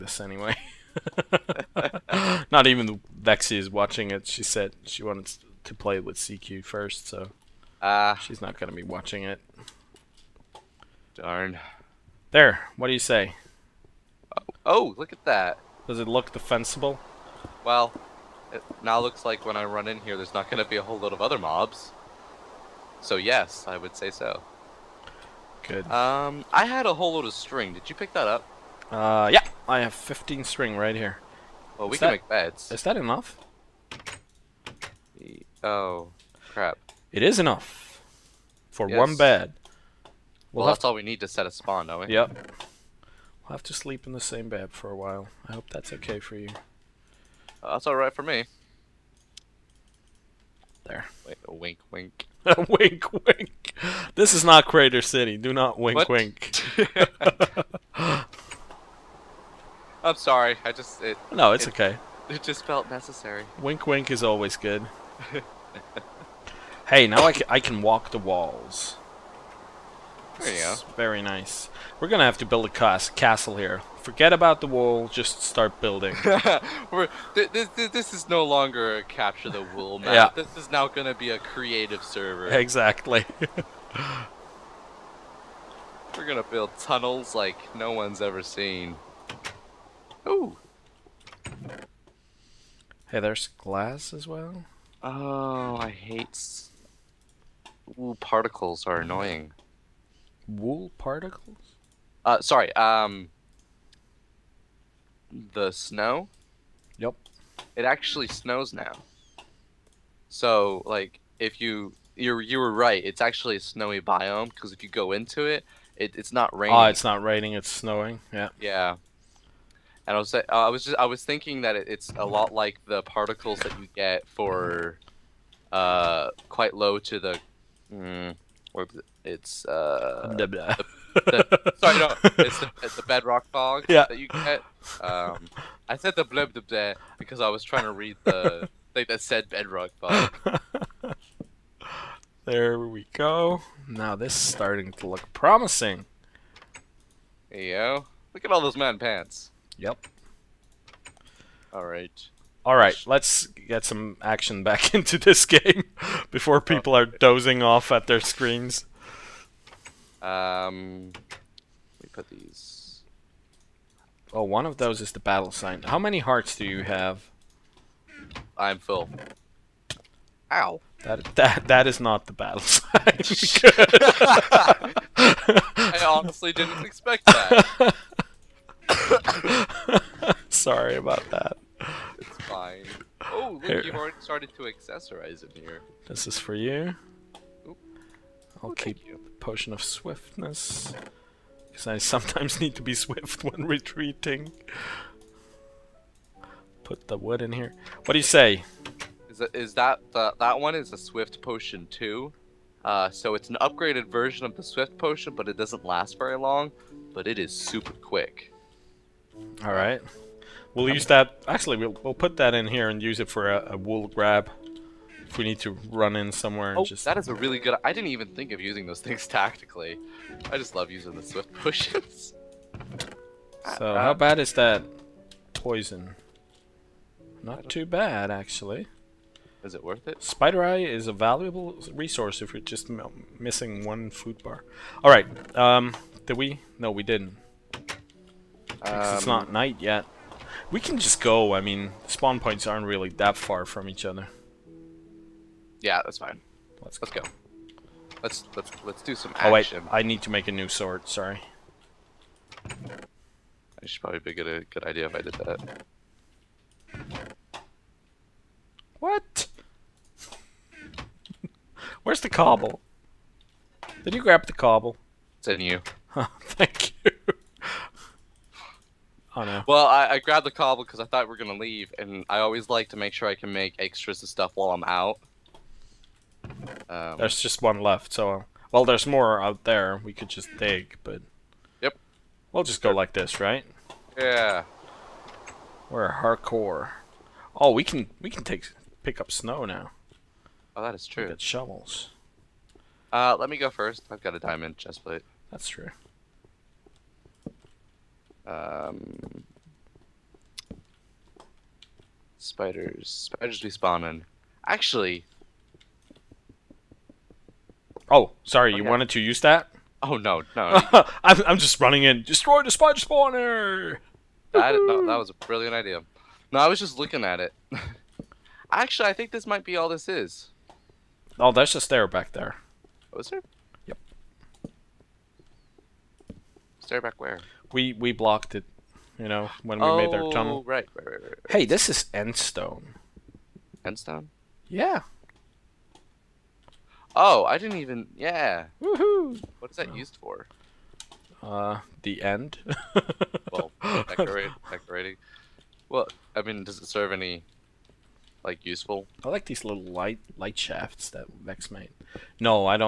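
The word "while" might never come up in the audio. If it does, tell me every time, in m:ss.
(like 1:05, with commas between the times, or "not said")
0:44, 4:34.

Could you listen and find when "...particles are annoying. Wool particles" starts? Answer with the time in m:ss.
1:38.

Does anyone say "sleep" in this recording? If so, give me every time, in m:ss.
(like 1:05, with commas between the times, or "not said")
0:43.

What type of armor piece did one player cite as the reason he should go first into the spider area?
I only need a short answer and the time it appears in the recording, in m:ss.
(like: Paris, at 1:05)
diamond chestplate, at 4:54.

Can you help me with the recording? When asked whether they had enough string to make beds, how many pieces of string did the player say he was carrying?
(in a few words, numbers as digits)
15.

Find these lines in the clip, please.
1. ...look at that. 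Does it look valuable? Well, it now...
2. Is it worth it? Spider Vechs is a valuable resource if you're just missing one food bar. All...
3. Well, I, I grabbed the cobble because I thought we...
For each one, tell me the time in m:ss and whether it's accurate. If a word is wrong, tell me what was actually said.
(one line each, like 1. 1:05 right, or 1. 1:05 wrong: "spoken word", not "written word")
1. 0:14 wrong: "defensible", not "valuable"
2. 3:49 wrong: "Eye", not "Vechs"
3. 4:29 right.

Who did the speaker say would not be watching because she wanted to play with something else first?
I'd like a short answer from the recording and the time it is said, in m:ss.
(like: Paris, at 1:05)
Vexy, at 0:03.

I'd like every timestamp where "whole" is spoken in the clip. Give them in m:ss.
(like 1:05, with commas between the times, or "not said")
0:20, 0:26.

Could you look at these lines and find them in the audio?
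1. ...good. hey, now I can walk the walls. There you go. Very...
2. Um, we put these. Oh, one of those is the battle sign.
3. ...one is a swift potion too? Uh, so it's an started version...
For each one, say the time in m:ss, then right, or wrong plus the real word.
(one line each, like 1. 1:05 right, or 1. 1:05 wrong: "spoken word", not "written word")
1. 1:04 right
2. 2:40 right
3. 3:20 wrong: "upgraded", not "started".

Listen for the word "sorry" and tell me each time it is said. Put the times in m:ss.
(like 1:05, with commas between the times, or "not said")
1:00, 1:42, 2:11, 3:00, 4:11, 5:08.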